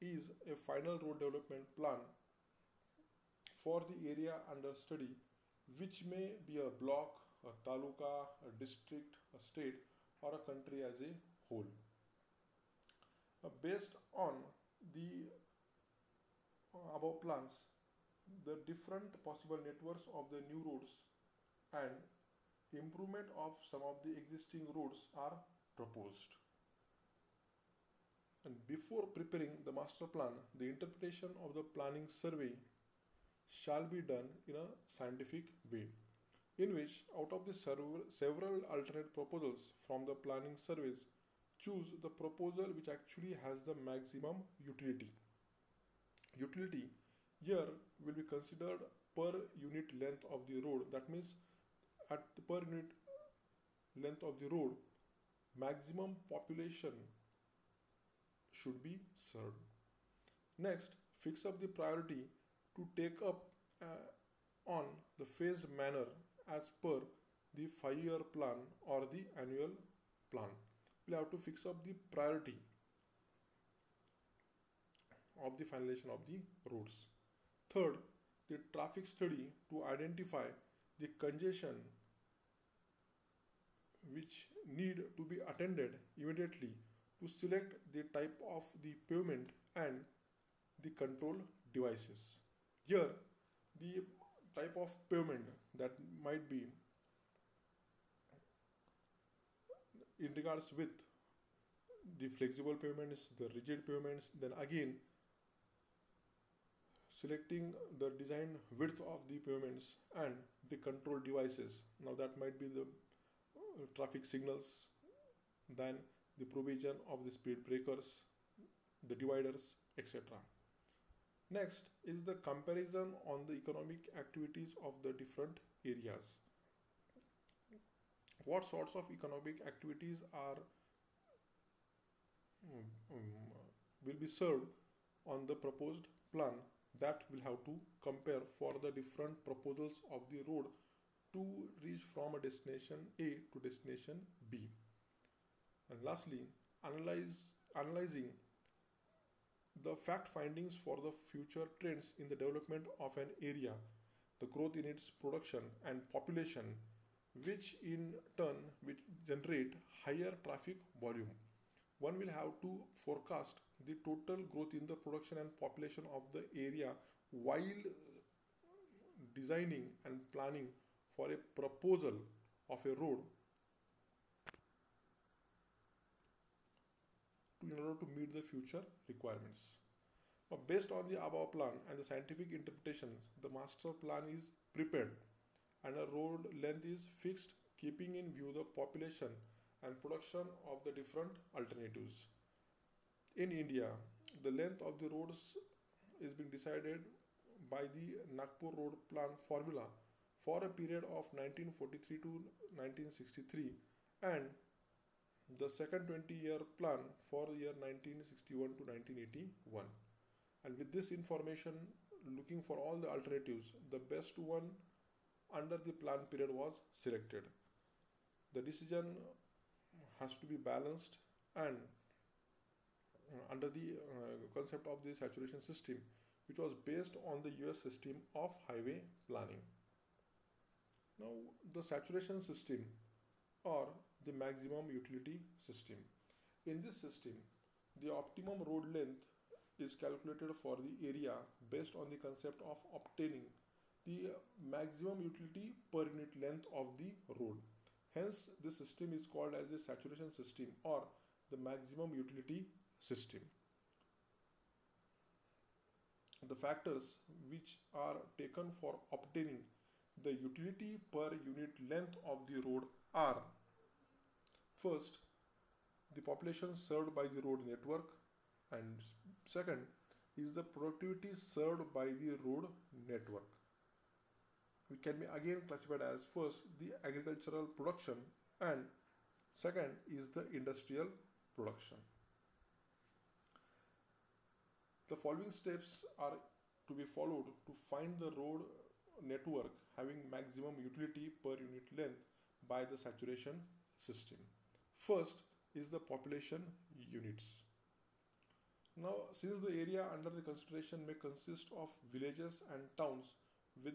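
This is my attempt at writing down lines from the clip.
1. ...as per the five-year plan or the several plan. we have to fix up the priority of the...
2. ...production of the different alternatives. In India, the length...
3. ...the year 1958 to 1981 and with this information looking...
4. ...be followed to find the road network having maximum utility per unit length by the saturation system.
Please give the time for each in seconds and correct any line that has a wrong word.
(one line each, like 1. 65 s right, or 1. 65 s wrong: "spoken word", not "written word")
1. 66 s wrong: "annual", not "several"
2. 190 s right
3. 207 s wrong: "1961", not "1958"
4. 287 s right.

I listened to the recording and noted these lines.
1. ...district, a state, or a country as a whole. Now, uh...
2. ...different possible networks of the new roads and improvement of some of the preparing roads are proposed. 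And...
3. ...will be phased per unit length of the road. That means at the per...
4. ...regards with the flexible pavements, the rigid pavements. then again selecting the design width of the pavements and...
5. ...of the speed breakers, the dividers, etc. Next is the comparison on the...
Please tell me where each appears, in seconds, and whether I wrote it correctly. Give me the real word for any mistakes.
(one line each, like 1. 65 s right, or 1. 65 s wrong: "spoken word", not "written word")
1. 8 s right
2. 18 s wrong: "existing", not "preparing"
3. 48 s wrong: "considered", not "phased"
4. 100 s right
5. 117 s right.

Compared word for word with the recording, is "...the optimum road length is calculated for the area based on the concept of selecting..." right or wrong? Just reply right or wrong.
wrong.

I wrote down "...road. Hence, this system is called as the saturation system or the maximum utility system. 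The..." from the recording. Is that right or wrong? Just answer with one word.
right.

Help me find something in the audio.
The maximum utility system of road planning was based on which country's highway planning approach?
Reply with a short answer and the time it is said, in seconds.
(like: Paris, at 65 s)
US, at 227 s.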